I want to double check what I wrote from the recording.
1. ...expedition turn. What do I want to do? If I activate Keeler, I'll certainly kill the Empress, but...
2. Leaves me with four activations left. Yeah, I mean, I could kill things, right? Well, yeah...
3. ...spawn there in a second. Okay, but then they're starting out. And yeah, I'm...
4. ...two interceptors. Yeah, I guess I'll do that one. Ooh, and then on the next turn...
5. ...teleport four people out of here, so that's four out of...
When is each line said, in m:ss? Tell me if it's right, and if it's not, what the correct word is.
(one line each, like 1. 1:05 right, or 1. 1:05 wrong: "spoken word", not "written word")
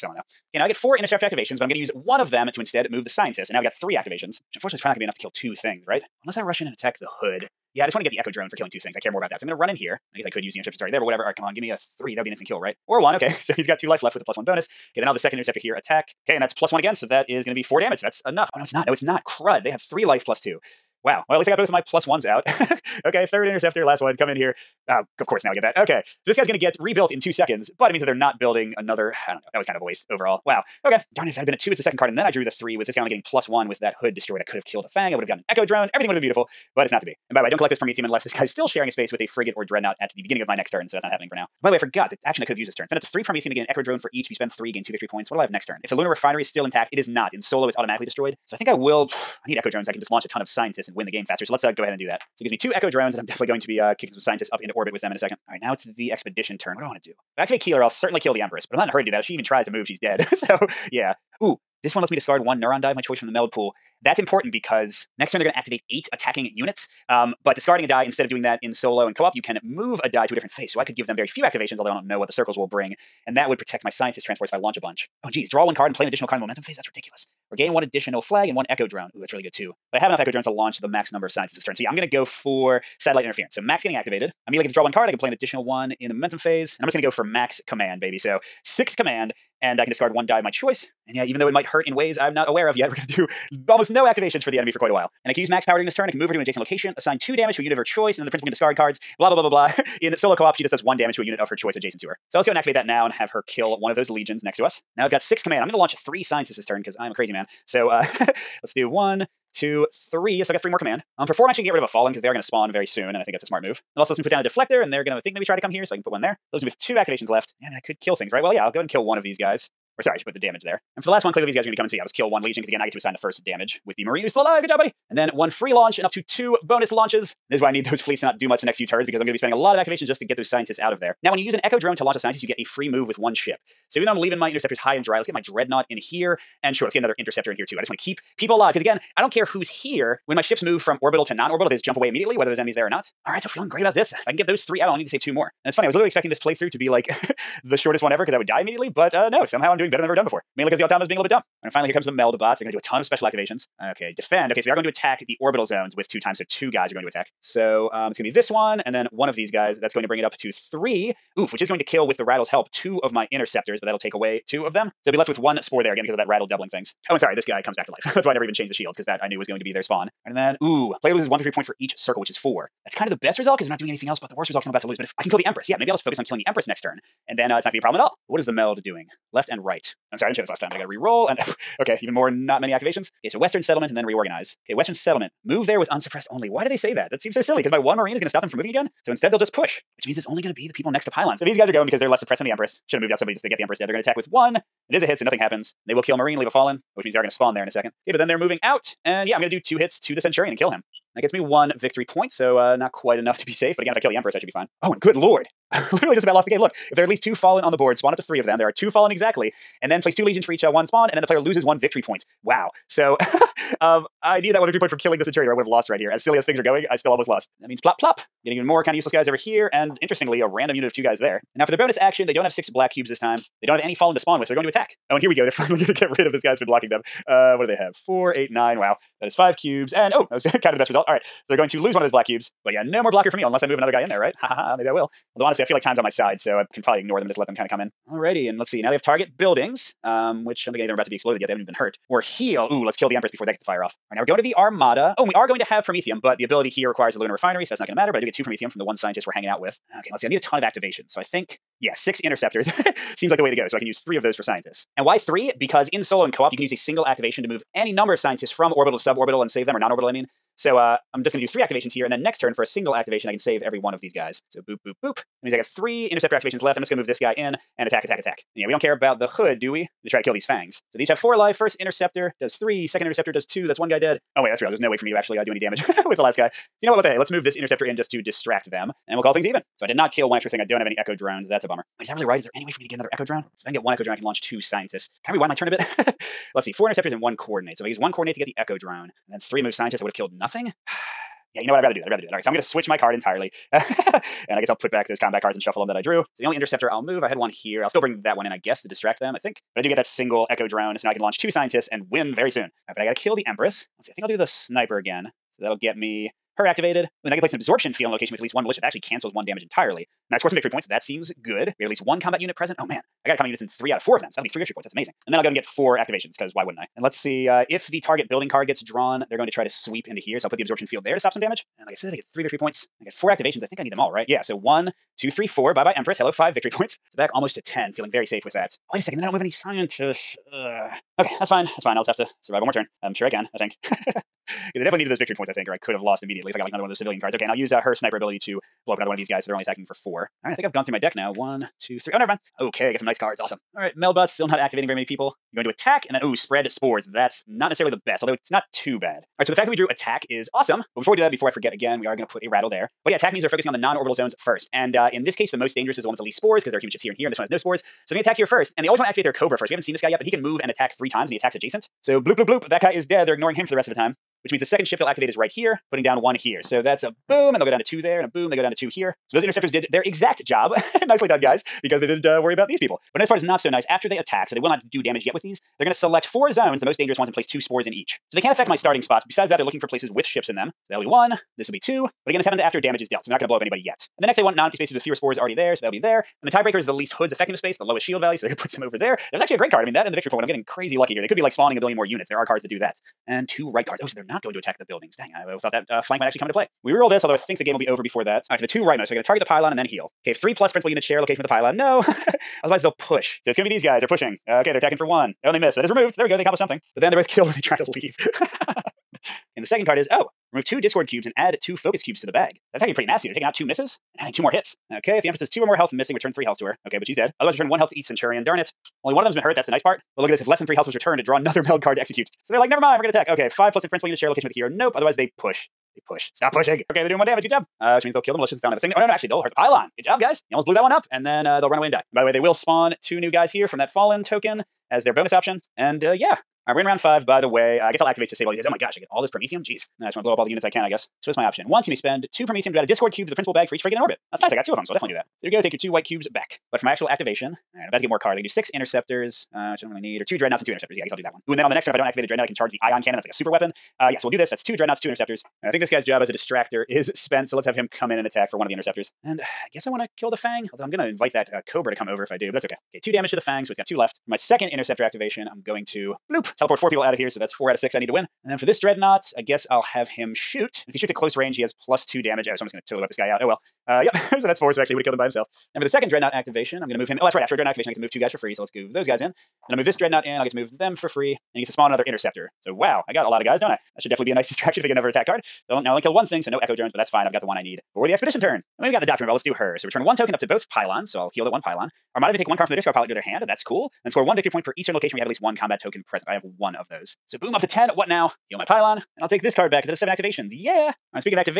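1. 0:56 right
2. 1:56 wrong: "two", not "four"
3. 3:17 wrong: "moving", not "starting"
4. 7:30 right
5. 7:46 right.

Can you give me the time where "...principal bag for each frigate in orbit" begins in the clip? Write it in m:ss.
7:23.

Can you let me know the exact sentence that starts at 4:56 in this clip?
So the only interceptor I'll move, I had one here.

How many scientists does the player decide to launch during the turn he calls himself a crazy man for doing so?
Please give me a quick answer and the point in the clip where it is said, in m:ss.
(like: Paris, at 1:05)
3, at 1:45.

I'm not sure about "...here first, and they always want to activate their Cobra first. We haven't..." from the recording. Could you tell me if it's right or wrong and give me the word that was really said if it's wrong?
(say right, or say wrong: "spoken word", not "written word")
right.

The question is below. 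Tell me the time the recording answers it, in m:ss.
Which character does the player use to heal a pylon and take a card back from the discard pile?
8:09.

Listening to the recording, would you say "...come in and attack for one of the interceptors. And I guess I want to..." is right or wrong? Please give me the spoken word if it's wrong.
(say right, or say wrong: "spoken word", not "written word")
right.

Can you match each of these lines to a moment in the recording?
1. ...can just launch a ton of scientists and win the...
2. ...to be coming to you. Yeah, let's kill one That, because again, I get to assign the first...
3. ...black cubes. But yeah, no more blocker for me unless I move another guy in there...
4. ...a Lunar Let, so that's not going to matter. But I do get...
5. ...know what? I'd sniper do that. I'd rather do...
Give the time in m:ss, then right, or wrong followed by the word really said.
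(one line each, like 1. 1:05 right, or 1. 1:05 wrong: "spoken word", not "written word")
1. 0:49 right
2. 2:01 wrong: "Legion", not "That"
3. 3:52 right
4. 4:07 wrong: "Refinery", not "Let"
5. 4:51 wrong: "rather", not "sniper".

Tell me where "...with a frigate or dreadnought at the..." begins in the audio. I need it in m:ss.
0:39.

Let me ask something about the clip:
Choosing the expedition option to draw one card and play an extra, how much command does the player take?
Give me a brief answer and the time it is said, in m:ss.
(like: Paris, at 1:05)
6, at 1:28.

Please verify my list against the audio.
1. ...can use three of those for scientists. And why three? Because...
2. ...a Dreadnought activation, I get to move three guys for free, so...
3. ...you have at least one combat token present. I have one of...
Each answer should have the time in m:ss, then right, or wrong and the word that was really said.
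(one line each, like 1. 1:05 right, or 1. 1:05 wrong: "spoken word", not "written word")
1. 4:13 right
2. 7:57 wrong: "two", not "three"
3. 8:15 right.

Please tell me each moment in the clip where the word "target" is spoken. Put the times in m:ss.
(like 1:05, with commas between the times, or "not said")
3:59, 5:17, 6:39.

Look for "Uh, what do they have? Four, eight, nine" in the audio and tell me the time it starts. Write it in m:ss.
3:47.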